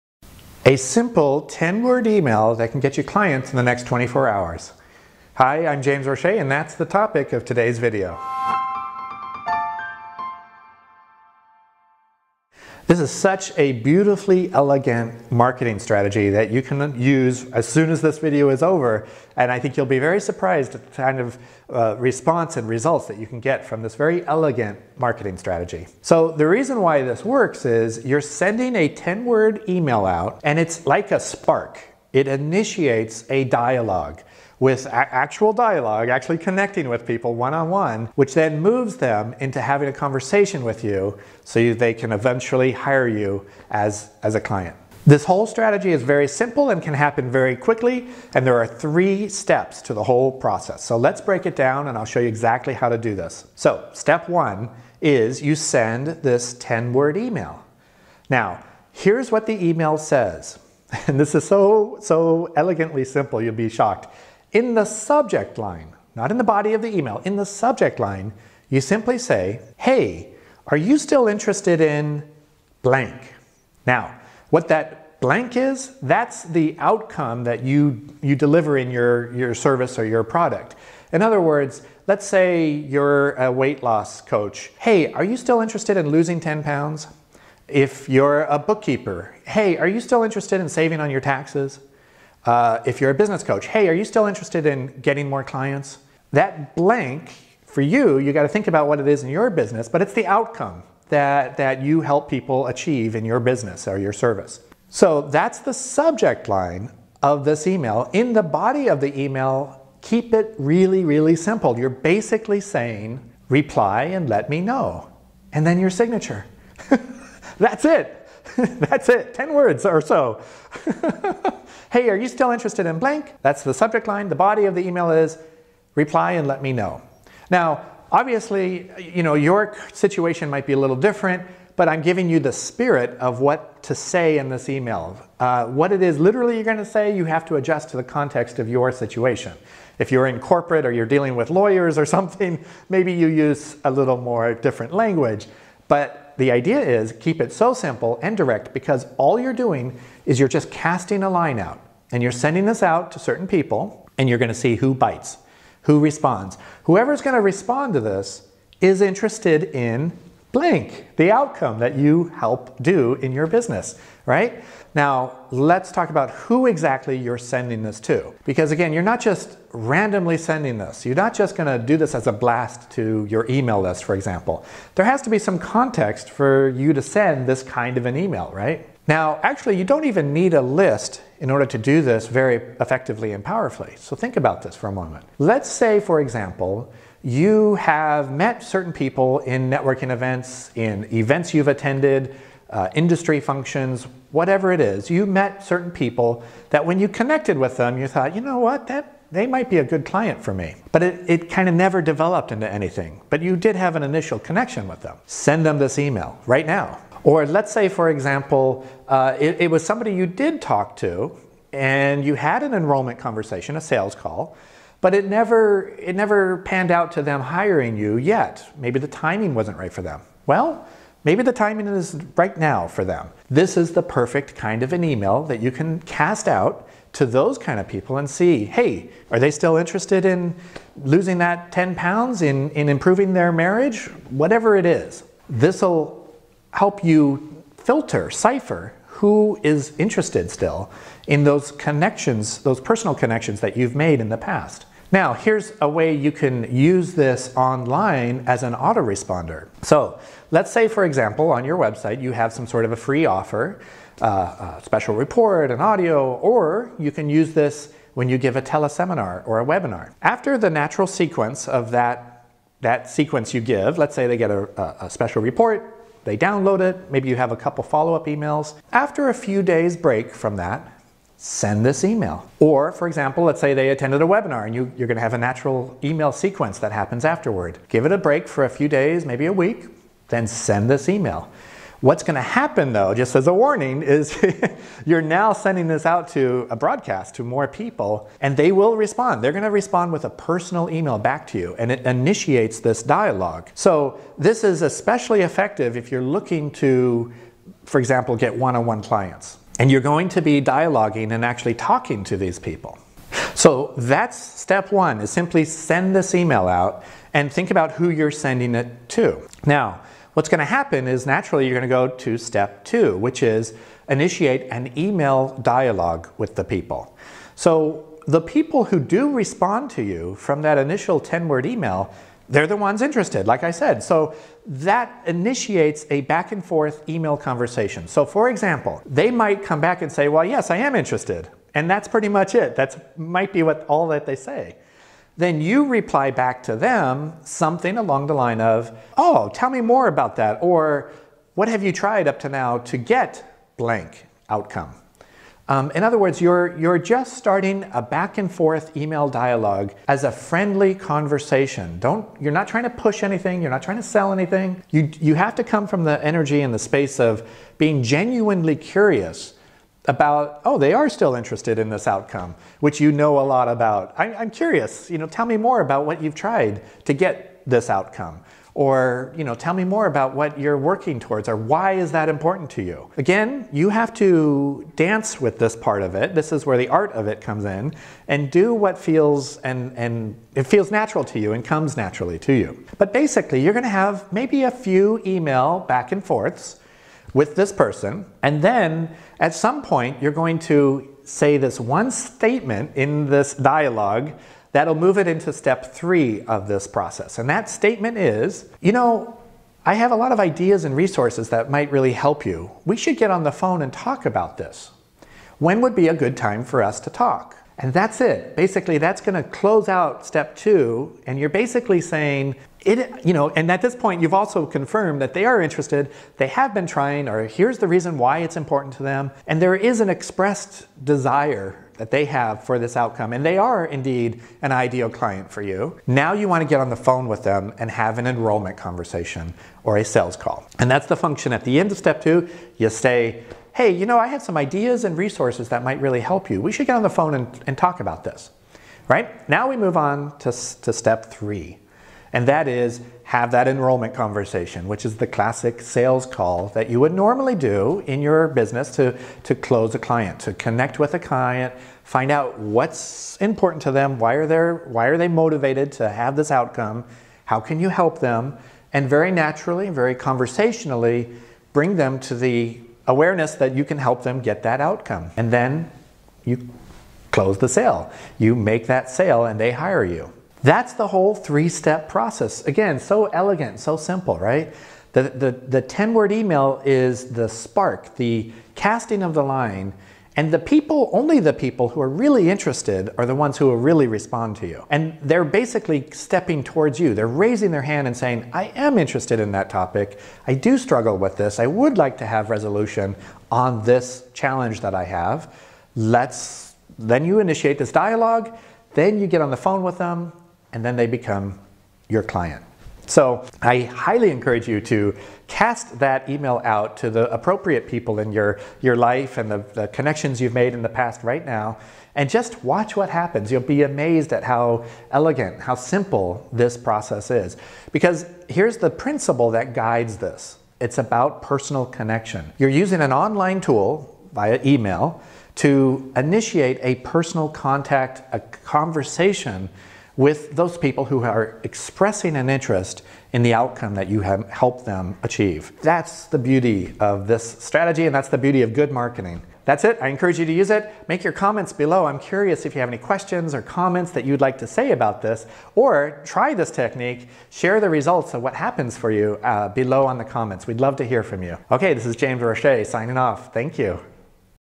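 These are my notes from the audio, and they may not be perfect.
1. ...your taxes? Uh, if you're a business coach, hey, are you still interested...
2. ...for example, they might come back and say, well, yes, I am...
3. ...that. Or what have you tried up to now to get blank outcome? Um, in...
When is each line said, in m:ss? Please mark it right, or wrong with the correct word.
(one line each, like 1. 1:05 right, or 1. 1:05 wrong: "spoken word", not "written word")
1. 1:31 right
2. 5:28 right
3. 5:40 right.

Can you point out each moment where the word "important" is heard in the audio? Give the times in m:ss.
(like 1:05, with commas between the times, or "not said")
6:12, 6:58, 7:33.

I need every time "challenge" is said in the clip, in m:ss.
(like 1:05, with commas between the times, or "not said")
8:14.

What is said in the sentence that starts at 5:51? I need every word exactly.
Don't, you're not trying to push anything.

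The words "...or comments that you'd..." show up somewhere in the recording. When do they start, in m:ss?
9:03.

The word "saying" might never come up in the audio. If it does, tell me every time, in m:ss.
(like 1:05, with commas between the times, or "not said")
1:52, 6:51, 8:08.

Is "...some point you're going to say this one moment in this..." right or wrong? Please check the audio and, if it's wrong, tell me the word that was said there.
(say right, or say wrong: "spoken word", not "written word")
wrong: "statement", not "moment".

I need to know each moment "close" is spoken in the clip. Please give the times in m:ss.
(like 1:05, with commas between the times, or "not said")
6:49, 7:29, 7:47.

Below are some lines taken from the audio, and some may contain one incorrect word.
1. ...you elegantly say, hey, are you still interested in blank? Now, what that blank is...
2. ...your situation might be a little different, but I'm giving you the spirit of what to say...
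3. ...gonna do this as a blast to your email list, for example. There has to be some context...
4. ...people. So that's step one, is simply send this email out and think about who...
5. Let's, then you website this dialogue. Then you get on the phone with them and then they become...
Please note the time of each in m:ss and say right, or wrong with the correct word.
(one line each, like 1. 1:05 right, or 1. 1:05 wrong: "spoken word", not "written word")
1. 1:08 wrong: "simply", not "elegantly"
2. 2:09 right
3. 2:51 right
4. 5:02 right
5. 8:15 wrong: "initiate", not "website".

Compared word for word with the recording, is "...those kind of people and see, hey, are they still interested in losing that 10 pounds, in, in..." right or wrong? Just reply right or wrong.
right.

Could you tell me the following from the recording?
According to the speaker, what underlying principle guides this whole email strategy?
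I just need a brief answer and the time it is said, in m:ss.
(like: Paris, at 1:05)
Personal connection, at 8:41.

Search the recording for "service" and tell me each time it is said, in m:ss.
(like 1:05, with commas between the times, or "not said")
1:19, 1:44.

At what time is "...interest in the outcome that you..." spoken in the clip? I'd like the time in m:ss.
8:52.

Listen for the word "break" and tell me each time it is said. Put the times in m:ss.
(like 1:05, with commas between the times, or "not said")
0:51, 4:29, 4:38.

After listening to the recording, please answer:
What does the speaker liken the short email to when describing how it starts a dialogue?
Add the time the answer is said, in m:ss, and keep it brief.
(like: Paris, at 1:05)
A spark, at 0:31.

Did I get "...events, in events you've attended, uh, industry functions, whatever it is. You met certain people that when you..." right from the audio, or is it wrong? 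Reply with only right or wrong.
right.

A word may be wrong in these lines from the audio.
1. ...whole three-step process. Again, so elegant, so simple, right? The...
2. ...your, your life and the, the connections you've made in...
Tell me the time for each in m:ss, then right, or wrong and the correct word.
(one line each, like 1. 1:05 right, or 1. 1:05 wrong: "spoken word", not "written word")
1. 7:51 right
2. 8:28 right.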